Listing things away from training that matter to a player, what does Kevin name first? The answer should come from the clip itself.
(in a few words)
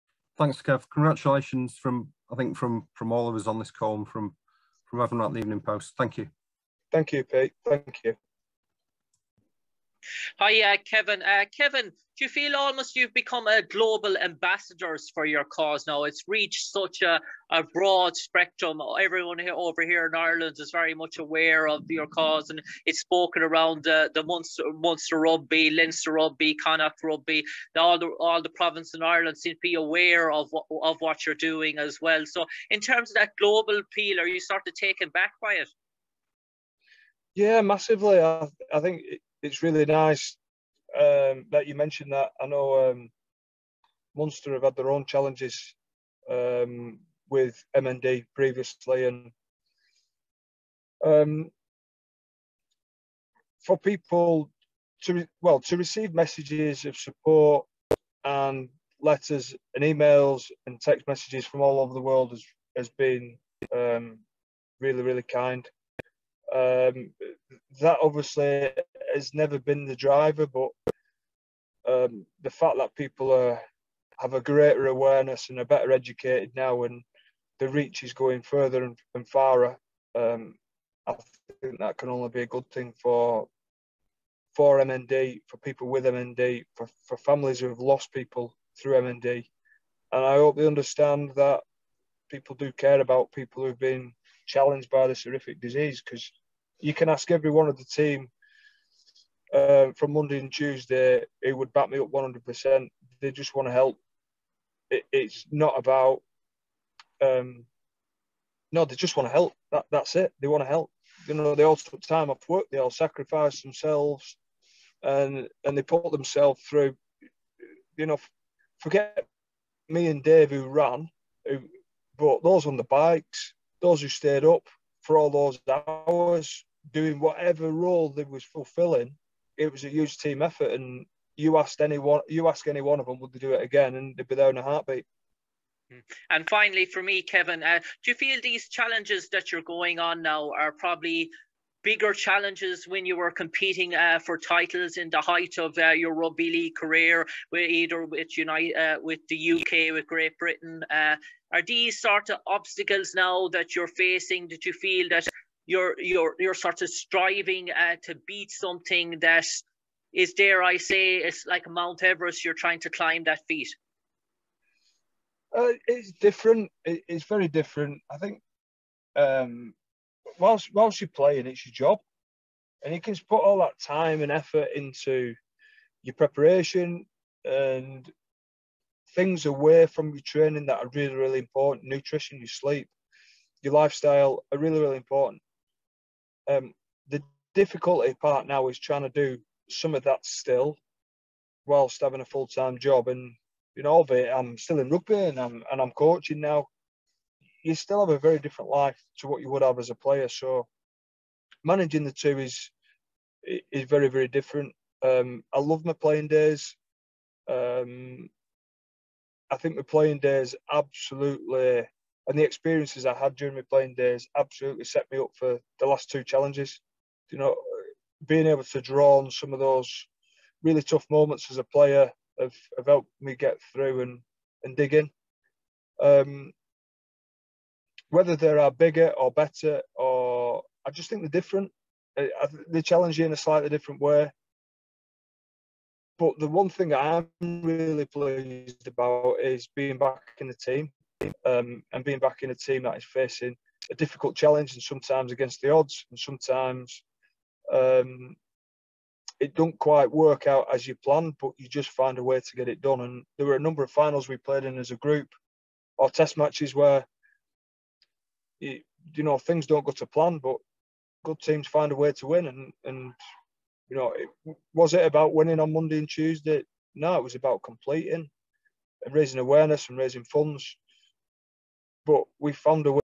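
Nutrition.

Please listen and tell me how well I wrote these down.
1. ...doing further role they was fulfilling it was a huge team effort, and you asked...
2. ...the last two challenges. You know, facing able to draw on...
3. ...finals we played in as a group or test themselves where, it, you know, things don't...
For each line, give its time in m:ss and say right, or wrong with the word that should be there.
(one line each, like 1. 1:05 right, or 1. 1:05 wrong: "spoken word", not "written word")
1. 2:06 wrong: "whatever", not "further"
2. 3:35 wrong: "being", not "facing"
3. 4:13 wrong: "matches", not "themselves".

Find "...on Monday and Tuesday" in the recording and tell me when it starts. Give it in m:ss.
4:25.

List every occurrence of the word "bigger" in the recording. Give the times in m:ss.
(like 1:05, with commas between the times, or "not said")
2:21, 3:48.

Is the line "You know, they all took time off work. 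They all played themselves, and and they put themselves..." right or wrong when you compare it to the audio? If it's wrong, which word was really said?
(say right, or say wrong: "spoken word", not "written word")
wrong: "sacrificed", not "played".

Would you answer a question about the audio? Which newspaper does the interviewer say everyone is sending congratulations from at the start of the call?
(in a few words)
Evening Post.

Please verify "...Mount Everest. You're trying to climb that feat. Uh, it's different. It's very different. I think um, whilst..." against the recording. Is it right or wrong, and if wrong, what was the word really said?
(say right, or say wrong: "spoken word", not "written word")
right.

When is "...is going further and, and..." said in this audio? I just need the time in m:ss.
1:18.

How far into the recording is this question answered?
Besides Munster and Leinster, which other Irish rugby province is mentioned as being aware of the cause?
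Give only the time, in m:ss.
0:26.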